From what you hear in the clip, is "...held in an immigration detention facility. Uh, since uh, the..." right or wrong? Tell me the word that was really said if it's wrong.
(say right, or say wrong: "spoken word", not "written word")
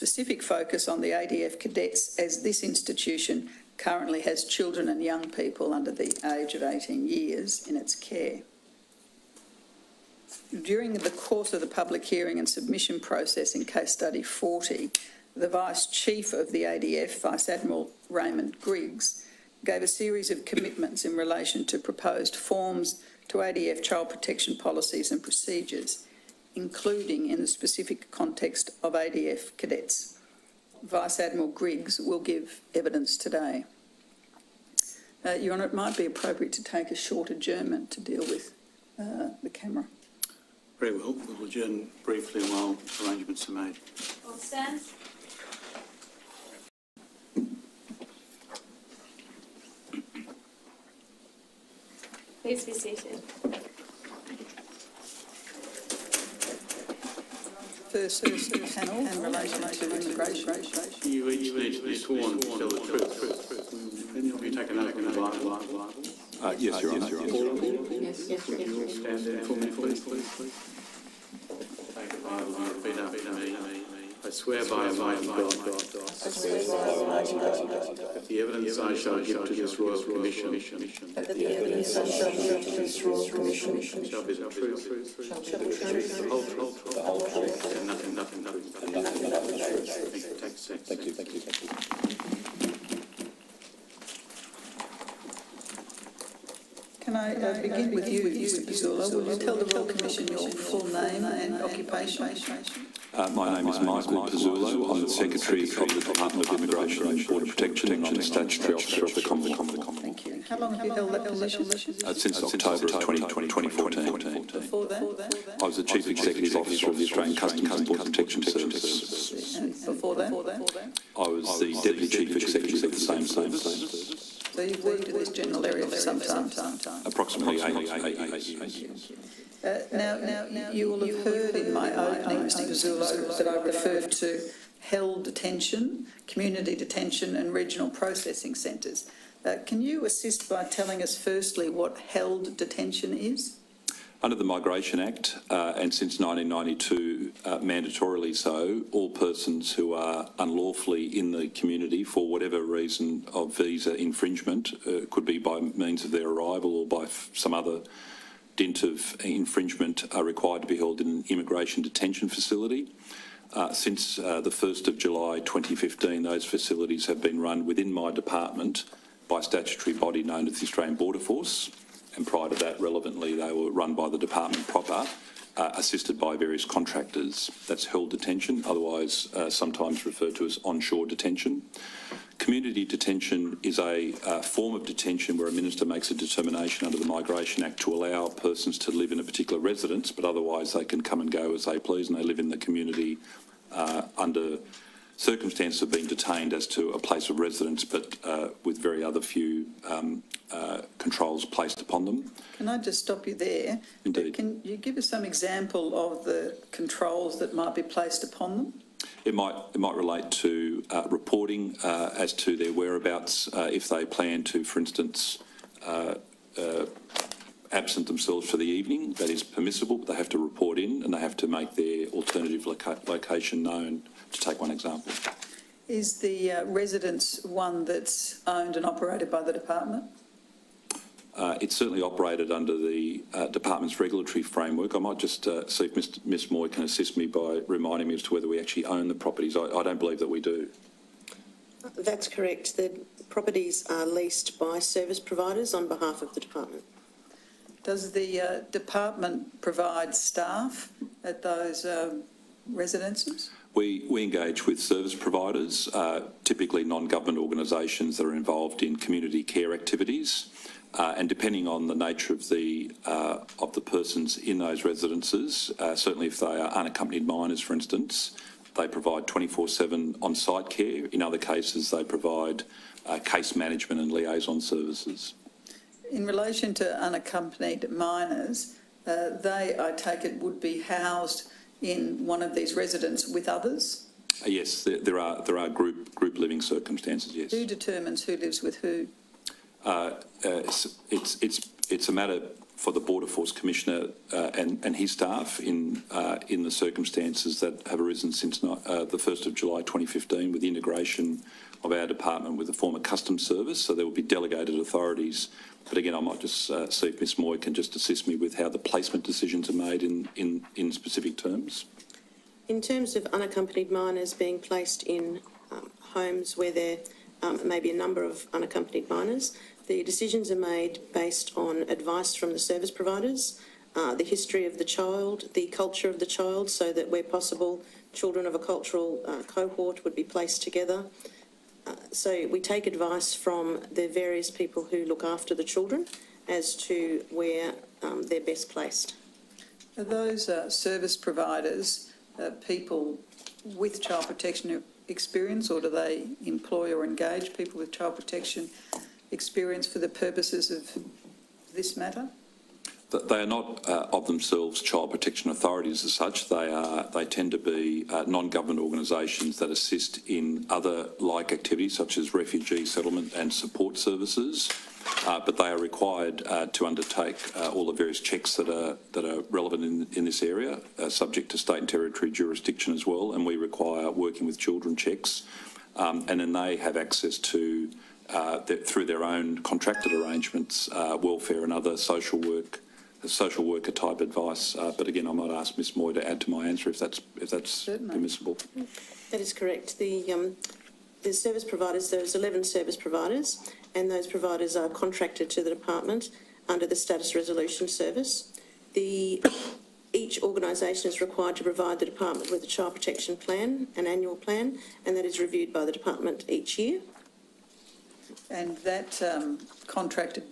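right.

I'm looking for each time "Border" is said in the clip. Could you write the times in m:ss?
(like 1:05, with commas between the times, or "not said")
1:47, 1:57, 2:50, 4:53.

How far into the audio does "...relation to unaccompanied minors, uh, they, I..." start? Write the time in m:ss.
4:36.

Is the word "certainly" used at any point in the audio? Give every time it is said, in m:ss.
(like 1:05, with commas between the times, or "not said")
3:51, 4:25, 6:27.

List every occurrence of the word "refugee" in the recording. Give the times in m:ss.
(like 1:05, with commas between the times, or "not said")
6:02.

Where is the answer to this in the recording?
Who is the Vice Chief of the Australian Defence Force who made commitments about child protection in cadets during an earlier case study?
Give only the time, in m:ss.
0:18.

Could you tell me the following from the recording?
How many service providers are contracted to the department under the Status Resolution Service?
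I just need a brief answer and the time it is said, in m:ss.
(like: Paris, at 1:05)
11, at 6:32.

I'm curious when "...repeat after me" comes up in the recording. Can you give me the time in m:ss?
1:12.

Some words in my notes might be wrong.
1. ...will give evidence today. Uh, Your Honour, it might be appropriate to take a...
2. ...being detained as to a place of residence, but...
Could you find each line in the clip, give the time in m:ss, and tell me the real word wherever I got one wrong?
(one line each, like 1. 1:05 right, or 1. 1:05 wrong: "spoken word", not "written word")
1. 0:32 right
2. 3:15 right.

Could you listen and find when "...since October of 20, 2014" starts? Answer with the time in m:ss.
1:52.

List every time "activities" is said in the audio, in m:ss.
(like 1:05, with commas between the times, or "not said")
4:19, 6:01.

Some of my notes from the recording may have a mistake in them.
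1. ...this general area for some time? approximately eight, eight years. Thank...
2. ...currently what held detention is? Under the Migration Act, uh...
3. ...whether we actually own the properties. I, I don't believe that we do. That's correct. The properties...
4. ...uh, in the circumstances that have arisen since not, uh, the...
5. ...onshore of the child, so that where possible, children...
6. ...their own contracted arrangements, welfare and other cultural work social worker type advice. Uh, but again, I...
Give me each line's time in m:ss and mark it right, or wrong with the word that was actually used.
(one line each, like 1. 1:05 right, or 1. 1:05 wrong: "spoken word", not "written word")
1. 2:05 right
2. 2:21 wrong: "firstly", not "currently"
3. 3:58 right
4. 4:56 right
5. 5:25 wrong: "culture", not "onshore"
6. 6:19 wrong: "social", not "cultural".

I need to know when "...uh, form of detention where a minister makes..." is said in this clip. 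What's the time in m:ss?
3:04.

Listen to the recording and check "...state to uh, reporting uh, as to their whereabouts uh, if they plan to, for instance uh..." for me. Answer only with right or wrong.
wrong.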